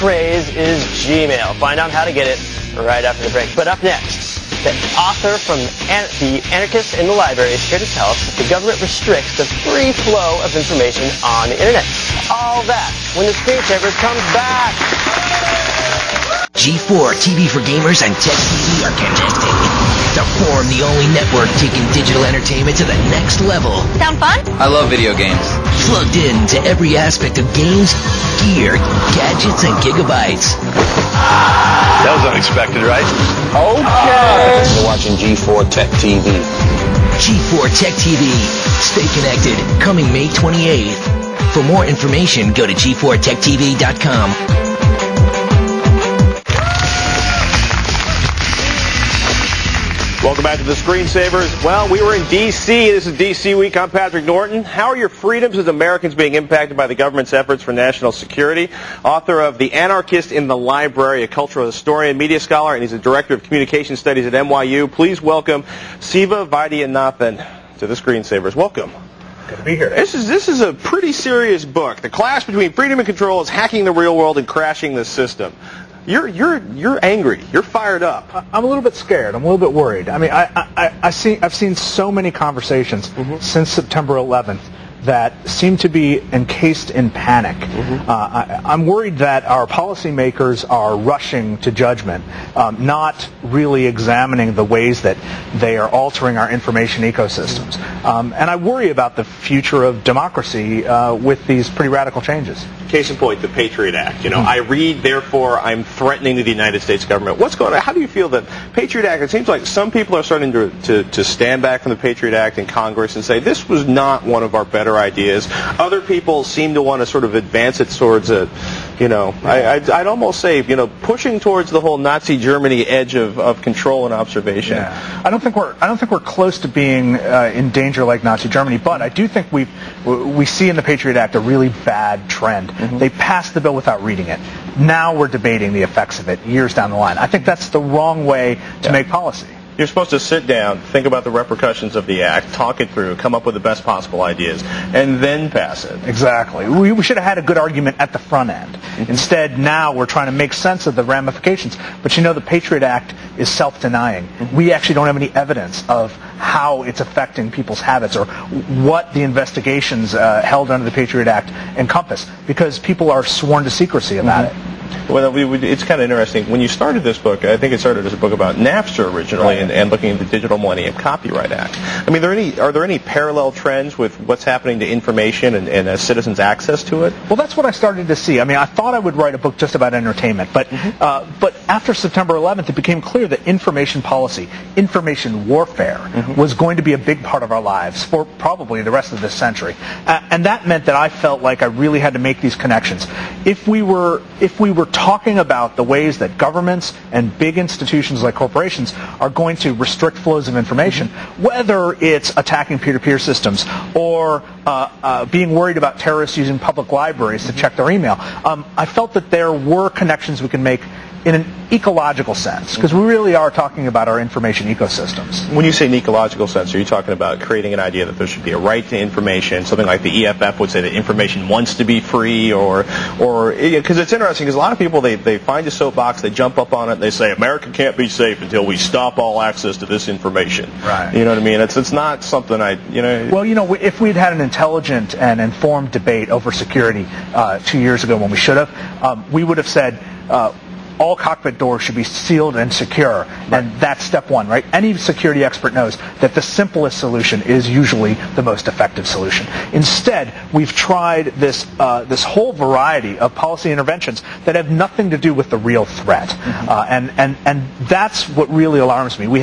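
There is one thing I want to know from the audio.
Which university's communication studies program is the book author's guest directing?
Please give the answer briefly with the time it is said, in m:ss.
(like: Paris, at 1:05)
NYU, at 1:04.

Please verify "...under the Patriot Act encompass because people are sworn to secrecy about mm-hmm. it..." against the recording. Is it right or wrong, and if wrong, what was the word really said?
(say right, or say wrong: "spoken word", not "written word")
right.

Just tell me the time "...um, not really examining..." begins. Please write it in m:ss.
1:32.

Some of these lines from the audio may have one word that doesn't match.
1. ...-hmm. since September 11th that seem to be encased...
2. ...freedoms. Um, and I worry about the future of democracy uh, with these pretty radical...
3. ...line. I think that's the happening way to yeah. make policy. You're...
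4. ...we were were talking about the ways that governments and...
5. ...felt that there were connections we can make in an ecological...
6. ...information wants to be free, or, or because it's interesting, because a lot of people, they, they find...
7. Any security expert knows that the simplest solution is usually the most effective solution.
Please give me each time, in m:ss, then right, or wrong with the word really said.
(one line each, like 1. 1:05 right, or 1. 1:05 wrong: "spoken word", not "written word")
1. 1:23 right
2. 1:37 wrong: "ecosystems", not "freedoms"
3. 2:16 wrong: "wrong", not "happening"
4. 3:14 right
5. 3:28 right
6. 3:40 right
7. 4:04 right.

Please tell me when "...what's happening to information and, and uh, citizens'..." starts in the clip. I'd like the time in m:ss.
2:54.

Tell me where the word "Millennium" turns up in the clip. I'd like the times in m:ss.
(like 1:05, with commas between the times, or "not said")
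2:50.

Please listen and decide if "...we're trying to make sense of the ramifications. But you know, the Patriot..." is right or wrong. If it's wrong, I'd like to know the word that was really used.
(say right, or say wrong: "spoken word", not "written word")
right.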